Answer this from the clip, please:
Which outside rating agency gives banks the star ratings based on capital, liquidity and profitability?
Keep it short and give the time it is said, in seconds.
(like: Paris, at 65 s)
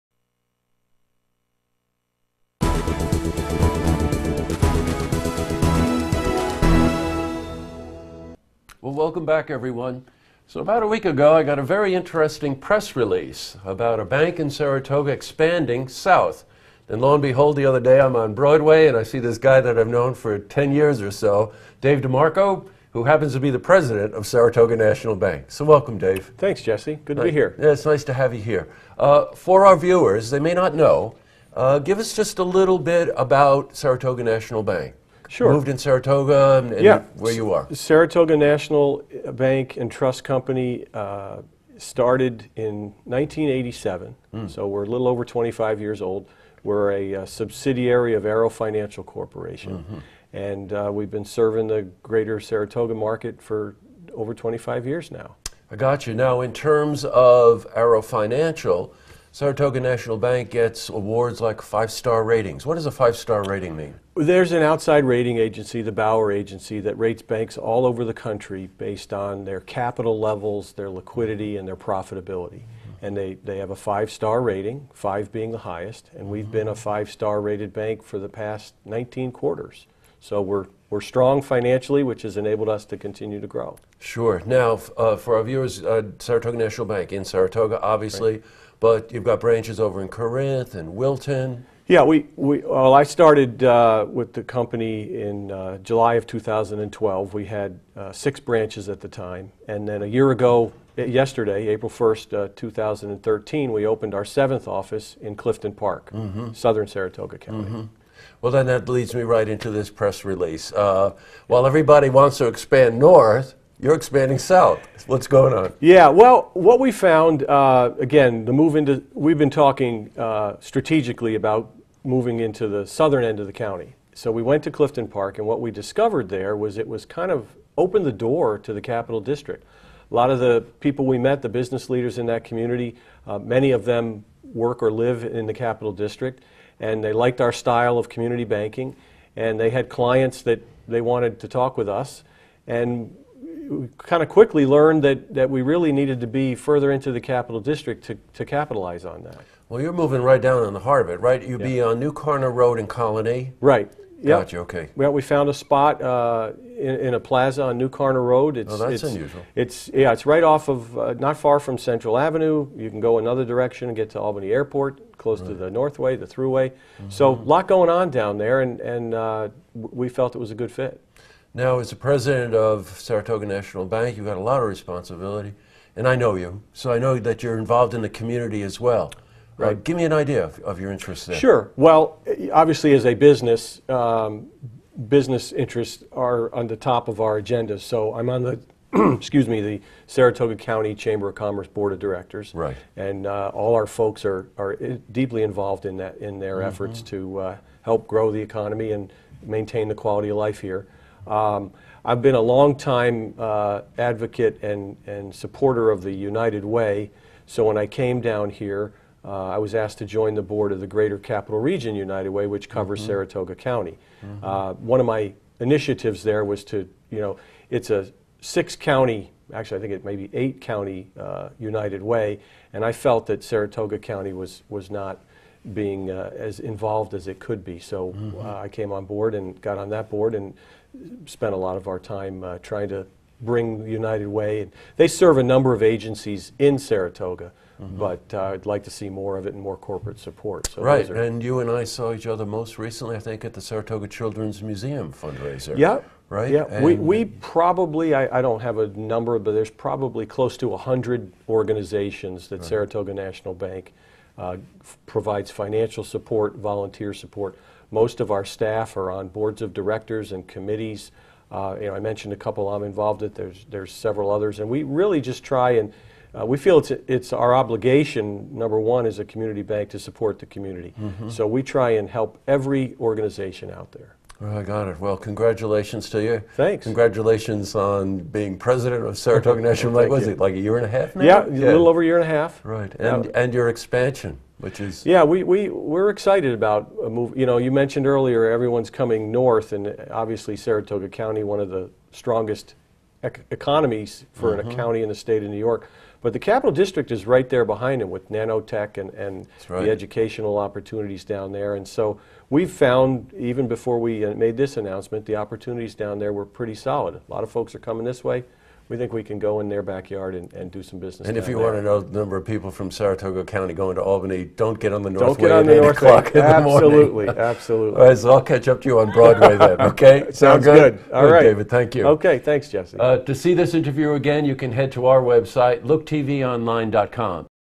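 Bauer Agency, at 65 s.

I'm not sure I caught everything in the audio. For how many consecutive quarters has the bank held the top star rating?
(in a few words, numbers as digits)
19.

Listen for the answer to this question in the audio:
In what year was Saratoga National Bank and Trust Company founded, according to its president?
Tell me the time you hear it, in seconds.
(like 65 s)
43 s.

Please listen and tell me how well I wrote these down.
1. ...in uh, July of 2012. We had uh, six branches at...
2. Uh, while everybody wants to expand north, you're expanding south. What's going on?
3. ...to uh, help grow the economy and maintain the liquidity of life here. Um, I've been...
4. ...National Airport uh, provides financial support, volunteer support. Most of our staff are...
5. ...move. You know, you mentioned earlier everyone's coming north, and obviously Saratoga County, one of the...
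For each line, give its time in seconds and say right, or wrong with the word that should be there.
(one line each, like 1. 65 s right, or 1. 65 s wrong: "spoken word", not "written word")
1. 95 s right
2. 110 s right
3. 197 s wrong: "quality", not "liquidity"
4. 253 s wrong: "Bank", not "Airport"
5. 287 s right.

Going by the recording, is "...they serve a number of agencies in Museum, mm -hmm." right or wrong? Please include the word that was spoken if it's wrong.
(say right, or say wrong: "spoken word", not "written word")
wrong: "Saratoga", not "Museum".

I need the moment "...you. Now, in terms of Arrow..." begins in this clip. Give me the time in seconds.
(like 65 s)
56 s.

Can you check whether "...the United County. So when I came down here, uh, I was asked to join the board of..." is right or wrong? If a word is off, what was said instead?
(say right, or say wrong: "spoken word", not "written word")
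wrong: "Way", not "County".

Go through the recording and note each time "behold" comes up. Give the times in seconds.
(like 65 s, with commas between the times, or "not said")
17 s.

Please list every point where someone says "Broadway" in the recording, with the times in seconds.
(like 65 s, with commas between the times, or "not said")
18 s, 319 s.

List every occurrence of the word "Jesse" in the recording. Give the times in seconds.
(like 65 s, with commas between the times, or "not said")
26 s, 322 s.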